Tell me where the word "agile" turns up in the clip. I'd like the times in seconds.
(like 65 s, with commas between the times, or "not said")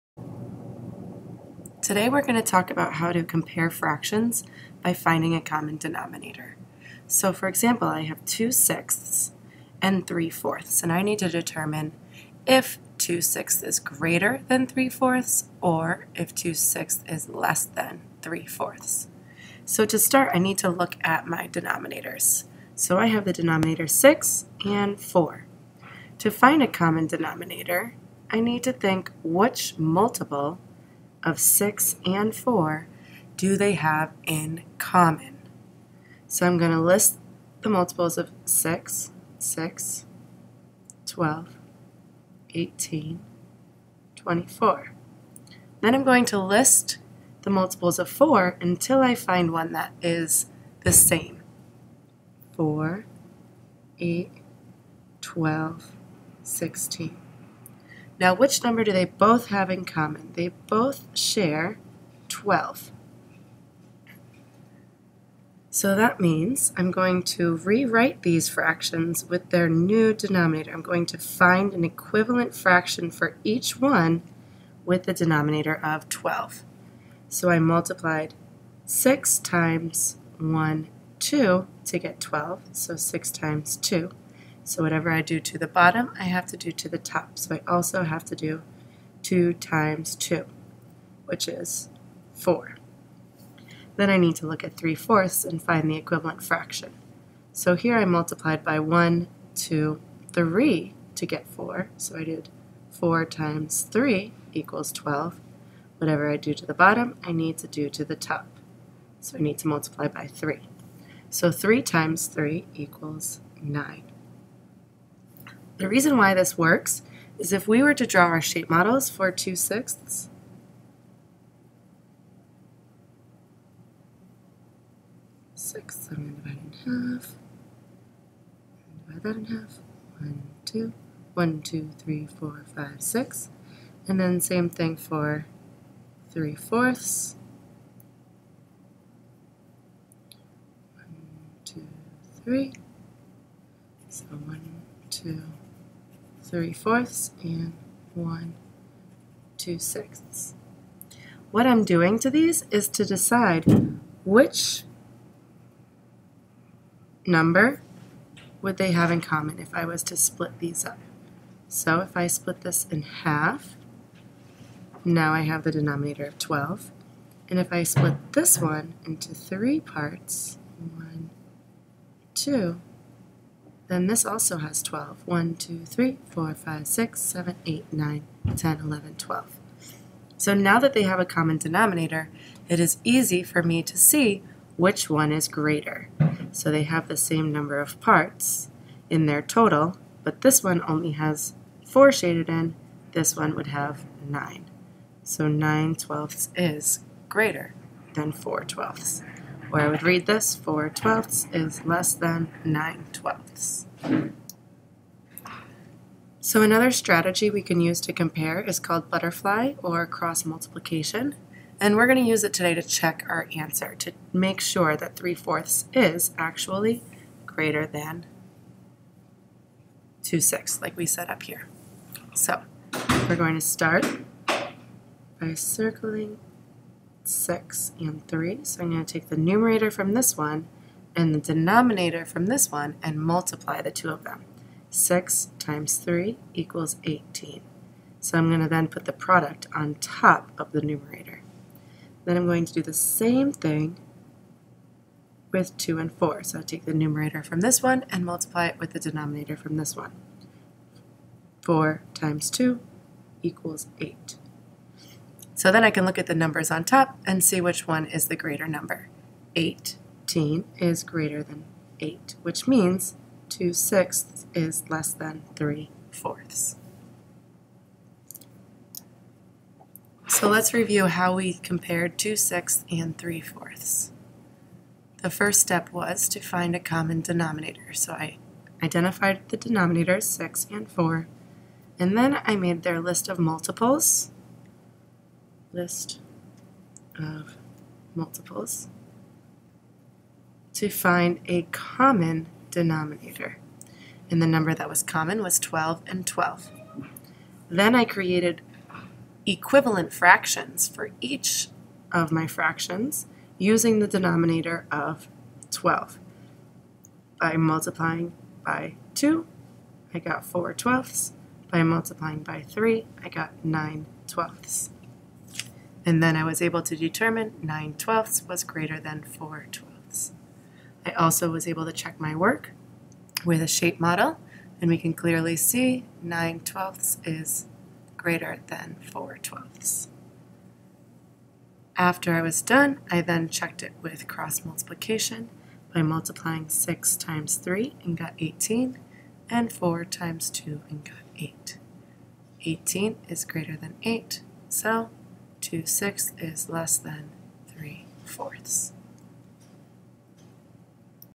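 not said.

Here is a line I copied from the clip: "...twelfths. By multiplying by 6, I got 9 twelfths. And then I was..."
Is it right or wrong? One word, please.
wrong.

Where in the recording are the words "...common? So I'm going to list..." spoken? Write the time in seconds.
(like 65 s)
34 s.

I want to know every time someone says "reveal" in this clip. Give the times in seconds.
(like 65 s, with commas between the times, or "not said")
not said.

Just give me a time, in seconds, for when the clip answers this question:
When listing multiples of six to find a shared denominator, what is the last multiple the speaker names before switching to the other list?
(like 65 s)
44 s.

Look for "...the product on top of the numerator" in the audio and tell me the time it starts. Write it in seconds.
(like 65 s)
239 s.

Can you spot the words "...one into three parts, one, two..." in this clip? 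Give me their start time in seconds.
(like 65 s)
168 s.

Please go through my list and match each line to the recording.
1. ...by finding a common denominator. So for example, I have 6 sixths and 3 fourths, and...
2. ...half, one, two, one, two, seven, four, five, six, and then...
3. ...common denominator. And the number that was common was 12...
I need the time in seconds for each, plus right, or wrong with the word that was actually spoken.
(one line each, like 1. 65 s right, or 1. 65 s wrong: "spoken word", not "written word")
1. 4 s wrong: "2", not "6"
2. 129 s wrong: "three", not "seven"
3. 291 s right.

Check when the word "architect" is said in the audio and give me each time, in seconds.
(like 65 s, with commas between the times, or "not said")
not said.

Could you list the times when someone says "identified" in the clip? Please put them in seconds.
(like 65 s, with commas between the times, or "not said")
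278 s.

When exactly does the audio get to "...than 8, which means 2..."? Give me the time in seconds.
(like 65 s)
261 s.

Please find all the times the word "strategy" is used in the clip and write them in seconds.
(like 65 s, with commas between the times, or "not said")
206 s.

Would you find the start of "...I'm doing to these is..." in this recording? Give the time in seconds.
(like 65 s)
151 s.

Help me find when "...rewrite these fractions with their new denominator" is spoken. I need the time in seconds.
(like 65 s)
67 s.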